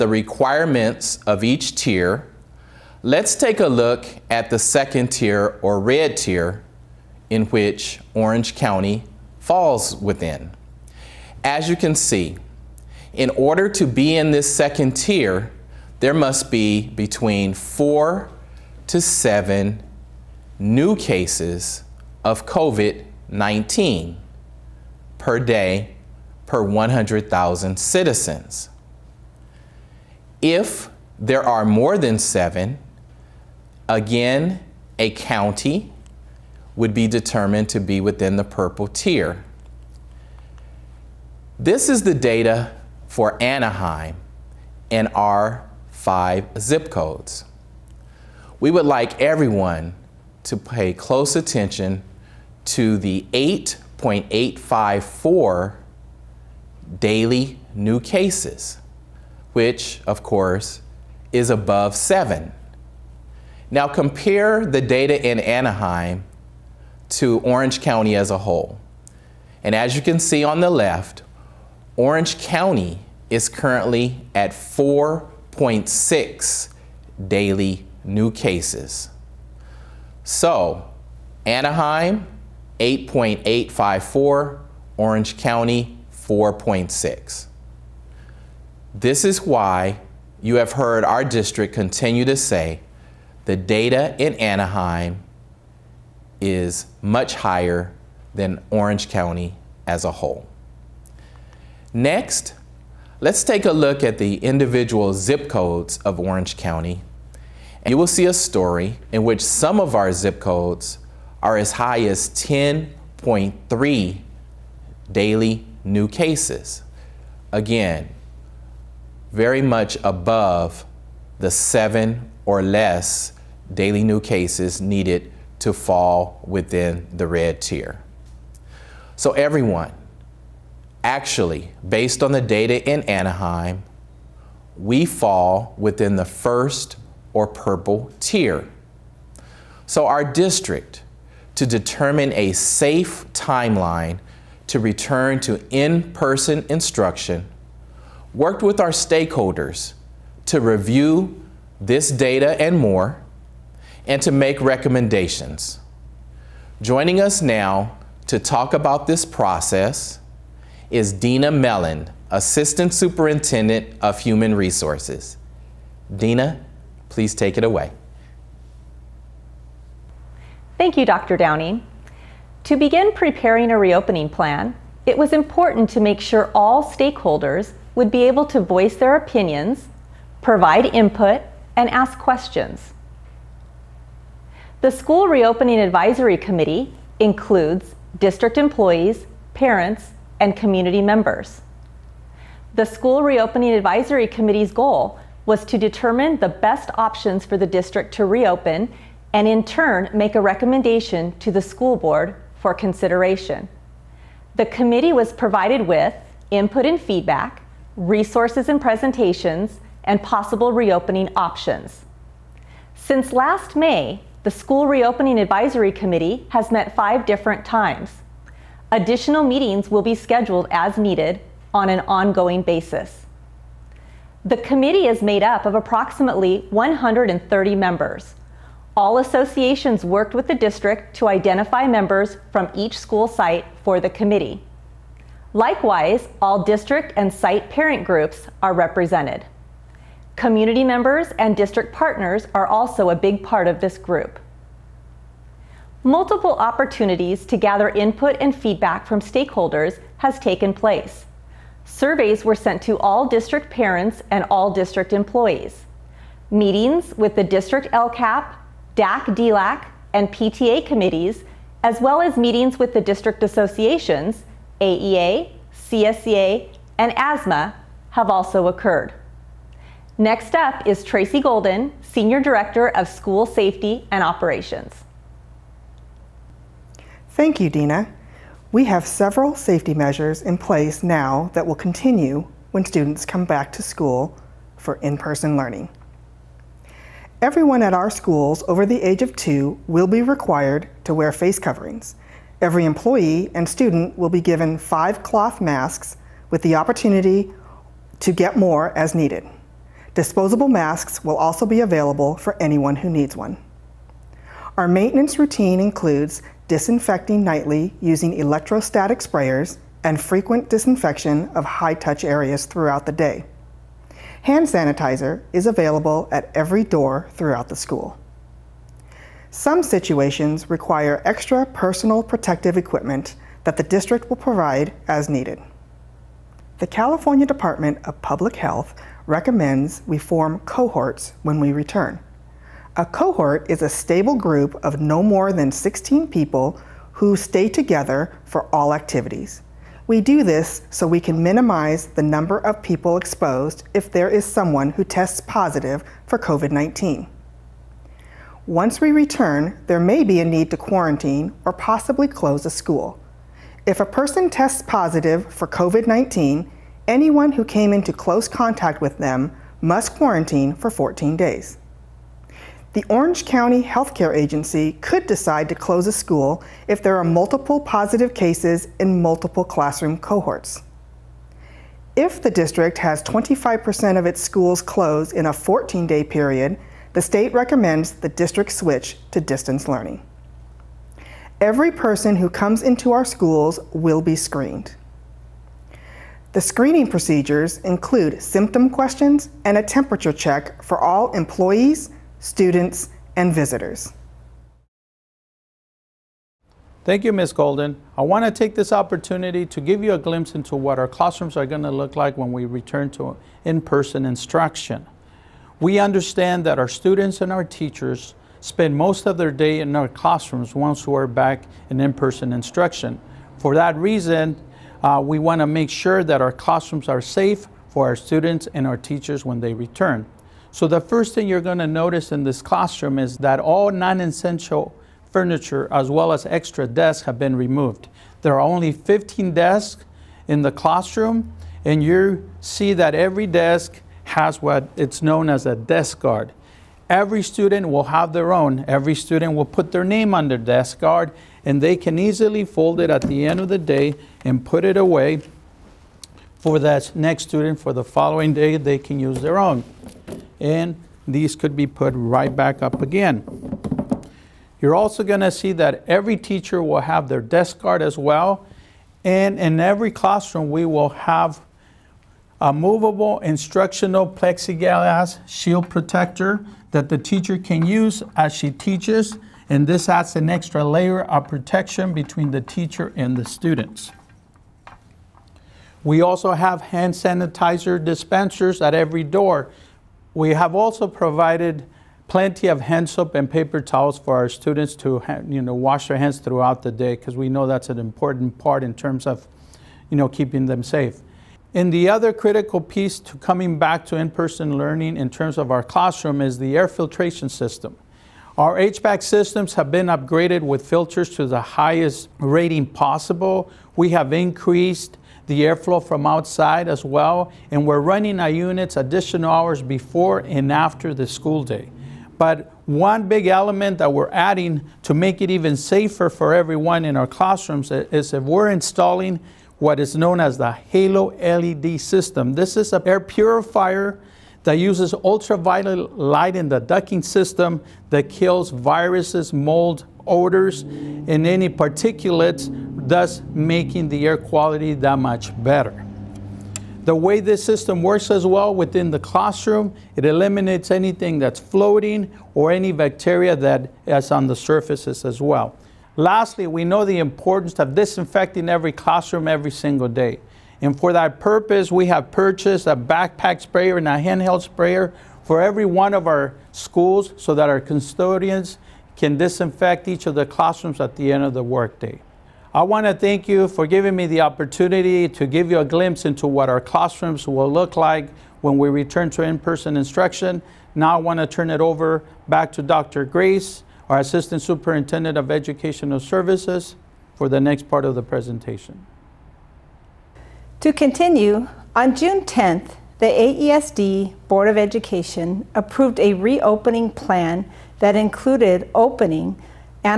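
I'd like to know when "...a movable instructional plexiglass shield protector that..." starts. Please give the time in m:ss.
7:42.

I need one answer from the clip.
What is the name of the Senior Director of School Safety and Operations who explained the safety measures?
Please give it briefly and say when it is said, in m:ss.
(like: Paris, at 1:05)
Tracy Golden, at 4:31.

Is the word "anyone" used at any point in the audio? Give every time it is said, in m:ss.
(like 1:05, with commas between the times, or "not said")
5:02, 5:57.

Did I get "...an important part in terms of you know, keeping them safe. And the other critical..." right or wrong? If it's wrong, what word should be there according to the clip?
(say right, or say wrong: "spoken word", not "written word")
right.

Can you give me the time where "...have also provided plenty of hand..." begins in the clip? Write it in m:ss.
8:00.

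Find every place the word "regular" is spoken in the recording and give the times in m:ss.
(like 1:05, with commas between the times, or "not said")
not said.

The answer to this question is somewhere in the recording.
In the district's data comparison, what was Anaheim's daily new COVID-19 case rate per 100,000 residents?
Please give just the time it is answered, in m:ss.
0:53.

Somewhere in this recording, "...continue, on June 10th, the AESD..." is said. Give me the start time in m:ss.
9:40.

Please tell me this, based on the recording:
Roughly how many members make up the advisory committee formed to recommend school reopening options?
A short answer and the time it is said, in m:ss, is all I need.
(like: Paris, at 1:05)
130, at 3:45.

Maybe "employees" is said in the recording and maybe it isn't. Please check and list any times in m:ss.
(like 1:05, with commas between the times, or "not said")
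3:08, 4:15, 4:52, 6:31.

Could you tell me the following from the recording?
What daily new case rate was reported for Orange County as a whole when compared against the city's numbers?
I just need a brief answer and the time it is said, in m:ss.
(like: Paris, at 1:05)
4.6, at 1:14.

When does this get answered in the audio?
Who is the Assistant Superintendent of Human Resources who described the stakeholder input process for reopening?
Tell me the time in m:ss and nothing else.
2:41.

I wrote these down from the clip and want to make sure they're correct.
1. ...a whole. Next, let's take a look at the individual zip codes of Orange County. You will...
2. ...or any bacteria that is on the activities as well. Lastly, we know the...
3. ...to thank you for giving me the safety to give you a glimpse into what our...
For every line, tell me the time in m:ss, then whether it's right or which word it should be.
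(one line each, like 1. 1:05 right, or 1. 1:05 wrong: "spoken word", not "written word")
1. 1:40 right
2. 9:02 wrong: "surfaces", not "activities"
3. 9:23 wrong: "opportunity", not "safety".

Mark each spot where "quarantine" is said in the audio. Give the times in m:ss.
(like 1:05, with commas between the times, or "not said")
5:50, 6:00.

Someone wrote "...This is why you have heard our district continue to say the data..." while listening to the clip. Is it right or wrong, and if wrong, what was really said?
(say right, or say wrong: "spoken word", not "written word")
right.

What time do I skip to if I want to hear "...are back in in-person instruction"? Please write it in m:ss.
6:51.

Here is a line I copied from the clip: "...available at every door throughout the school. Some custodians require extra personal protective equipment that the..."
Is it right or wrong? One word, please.
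wrong.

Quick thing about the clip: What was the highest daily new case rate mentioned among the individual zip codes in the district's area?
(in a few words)
10.3.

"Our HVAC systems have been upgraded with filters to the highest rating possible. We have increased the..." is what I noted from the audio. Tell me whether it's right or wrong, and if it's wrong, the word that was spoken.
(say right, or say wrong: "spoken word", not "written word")
right.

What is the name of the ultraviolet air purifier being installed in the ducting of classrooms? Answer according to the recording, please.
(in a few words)
Halo LED system.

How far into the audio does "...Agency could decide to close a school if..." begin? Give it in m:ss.
6:04.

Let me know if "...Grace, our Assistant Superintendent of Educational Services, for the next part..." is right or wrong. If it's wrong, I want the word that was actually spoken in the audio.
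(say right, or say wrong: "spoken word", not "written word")
right.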